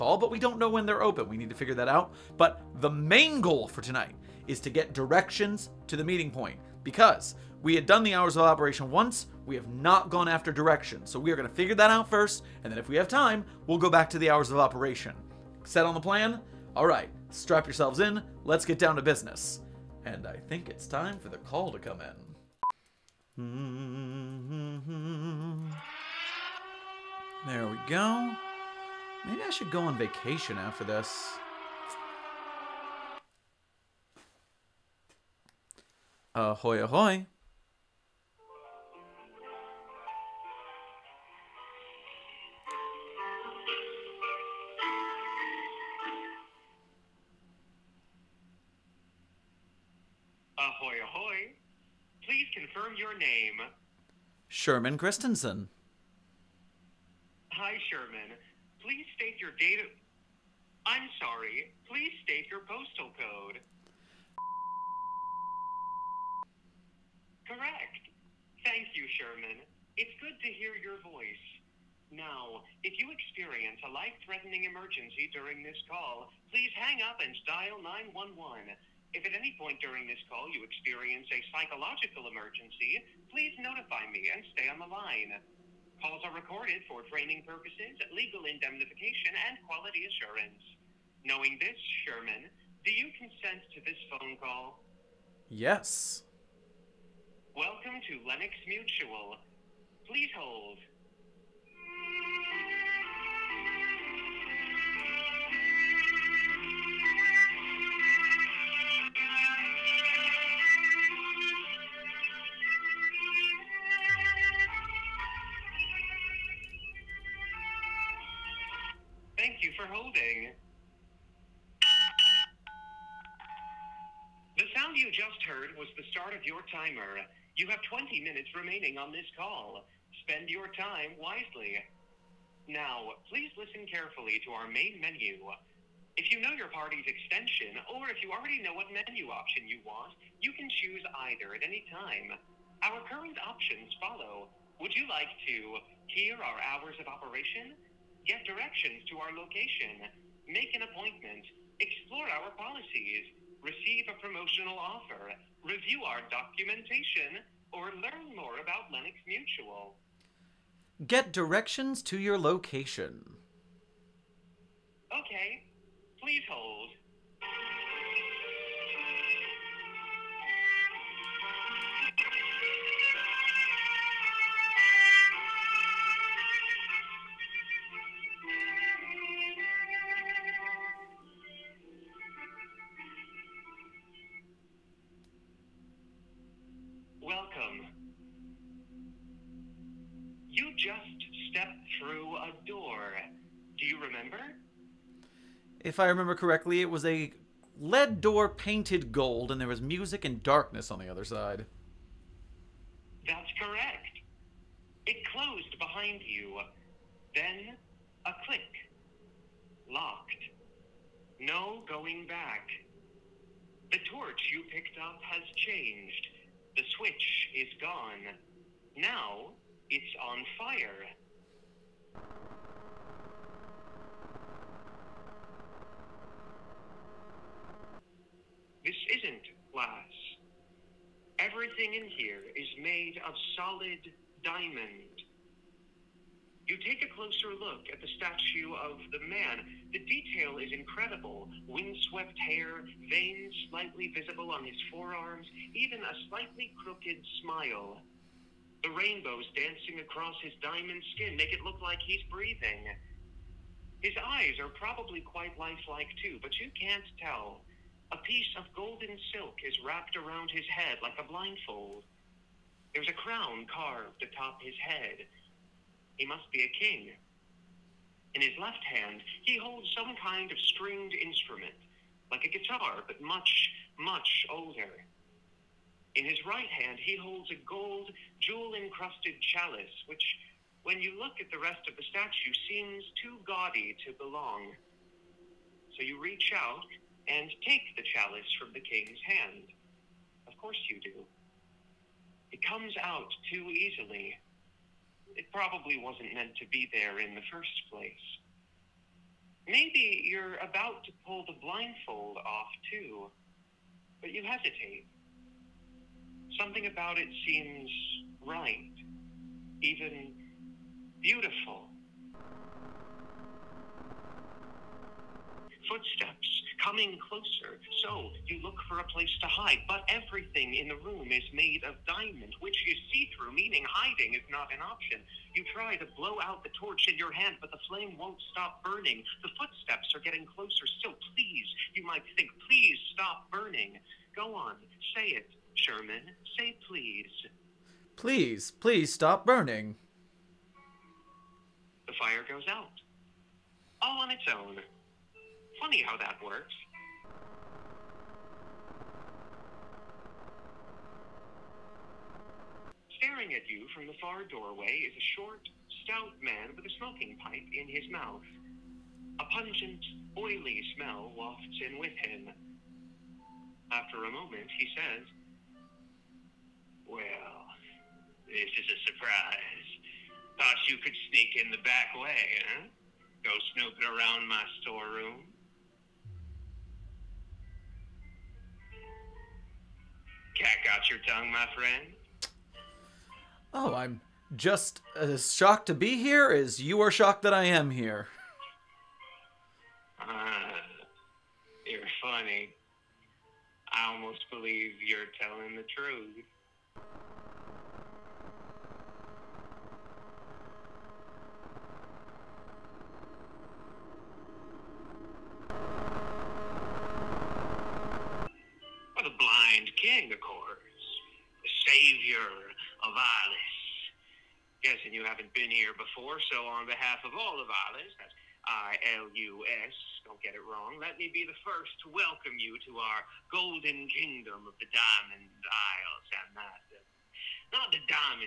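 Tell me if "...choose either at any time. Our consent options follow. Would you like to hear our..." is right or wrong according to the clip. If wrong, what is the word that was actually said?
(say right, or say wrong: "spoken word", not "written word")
wrong: "current", not "consent".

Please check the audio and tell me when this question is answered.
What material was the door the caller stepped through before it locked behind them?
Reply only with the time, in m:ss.
3:17.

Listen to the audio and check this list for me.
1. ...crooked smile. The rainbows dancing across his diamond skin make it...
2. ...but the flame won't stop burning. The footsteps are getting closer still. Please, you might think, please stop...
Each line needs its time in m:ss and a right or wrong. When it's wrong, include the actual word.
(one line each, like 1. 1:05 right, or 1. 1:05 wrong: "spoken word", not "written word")
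1. 4:06 right
2. 5:27 right.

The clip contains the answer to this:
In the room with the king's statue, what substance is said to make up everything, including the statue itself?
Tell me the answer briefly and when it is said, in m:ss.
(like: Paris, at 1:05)
solid diamond, at 3:53.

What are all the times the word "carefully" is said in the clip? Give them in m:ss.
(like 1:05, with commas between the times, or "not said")
2:13.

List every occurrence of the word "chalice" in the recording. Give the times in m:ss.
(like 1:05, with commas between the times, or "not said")
4:39, 4:48.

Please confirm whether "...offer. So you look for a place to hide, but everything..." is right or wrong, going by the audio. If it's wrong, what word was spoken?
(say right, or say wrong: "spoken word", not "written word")
wrong: "closer", not "offer".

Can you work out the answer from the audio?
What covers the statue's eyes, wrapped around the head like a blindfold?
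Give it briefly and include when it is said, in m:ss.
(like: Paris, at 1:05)
golden silk, at 4:18.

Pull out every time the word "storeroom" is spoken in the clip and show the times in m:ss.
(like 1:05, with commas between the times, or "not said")
6:14.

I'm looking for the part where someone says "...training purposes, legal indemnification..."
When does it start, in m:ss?
1:27.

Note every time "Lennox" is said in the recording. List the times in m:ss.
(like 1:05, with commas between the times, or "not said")
1:38, 2:38.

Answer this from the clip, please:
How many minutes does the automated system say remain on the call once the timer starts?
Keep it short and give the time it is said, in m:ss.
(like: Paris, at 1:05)
20, at 2:07.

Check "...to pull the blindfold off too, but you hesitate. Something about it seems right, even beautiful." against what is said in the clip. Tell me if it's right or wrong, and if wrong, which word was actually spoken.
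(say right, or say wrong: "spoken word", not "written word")
right.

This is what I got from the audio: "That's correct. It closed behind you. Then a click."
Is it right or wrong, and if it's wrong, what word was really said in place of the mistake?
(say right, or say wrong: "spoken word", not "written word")
right.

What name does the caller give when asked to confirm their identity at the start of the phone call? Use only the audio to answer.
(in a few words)
Sherman Christensen.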